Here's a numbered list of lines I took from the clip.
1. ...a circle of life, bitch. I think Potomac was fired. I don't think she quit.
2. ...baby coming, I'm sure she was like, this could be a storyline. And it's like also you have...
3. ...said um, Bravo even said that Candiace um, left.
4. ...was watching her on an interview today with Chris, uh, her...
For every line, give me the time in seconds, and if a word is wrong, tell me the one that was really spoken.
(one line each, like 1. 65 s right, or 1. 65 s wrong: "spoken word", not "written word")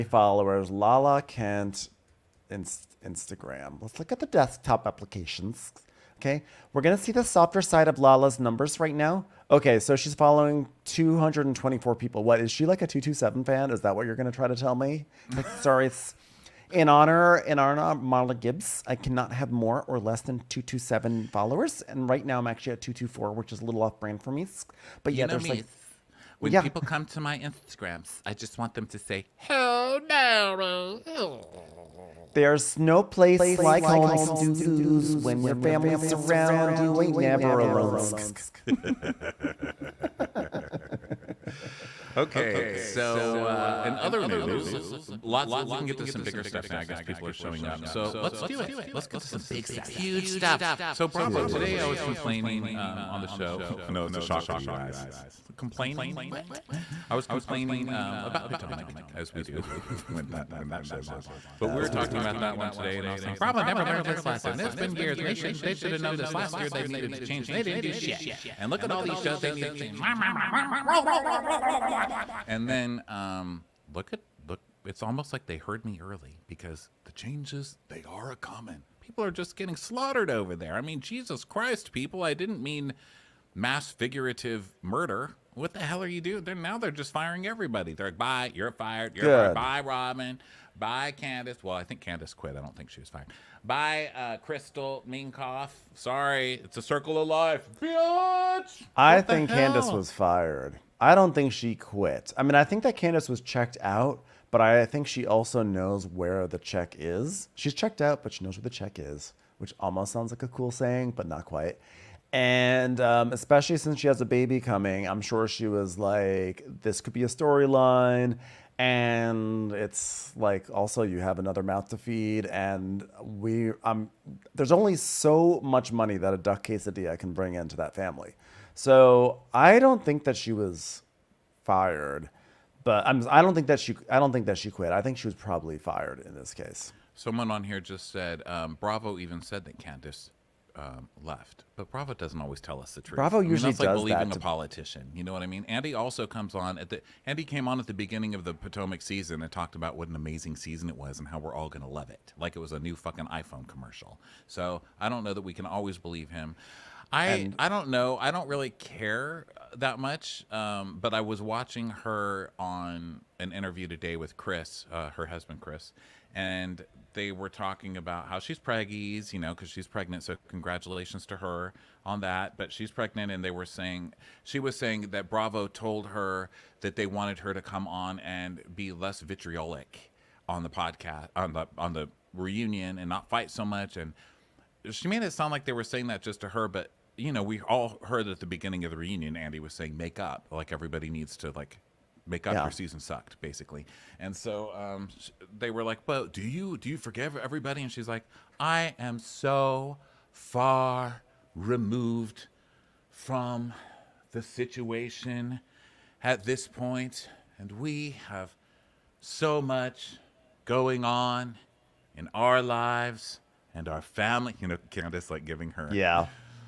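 1. 96 s wrong: "Candiace", not "Potomac"
2. 114 s right
3. 138 s right
4. 161 s right.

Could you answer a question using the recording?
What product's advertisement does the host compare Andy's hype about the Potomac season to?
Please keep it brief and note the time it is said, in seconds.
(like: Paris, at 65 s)
iPhone, at 153 s.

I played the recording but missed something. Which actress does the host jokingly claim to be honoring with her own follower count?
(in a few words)
Marla Gibbs.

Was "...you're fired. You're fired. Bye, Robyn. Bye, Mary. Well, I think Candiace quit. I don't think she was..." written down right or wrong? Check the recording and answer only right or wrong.
wrong.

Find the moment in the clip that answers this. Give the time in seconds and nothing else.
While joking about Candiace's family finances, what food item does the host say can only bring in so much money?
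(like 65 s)
126 s.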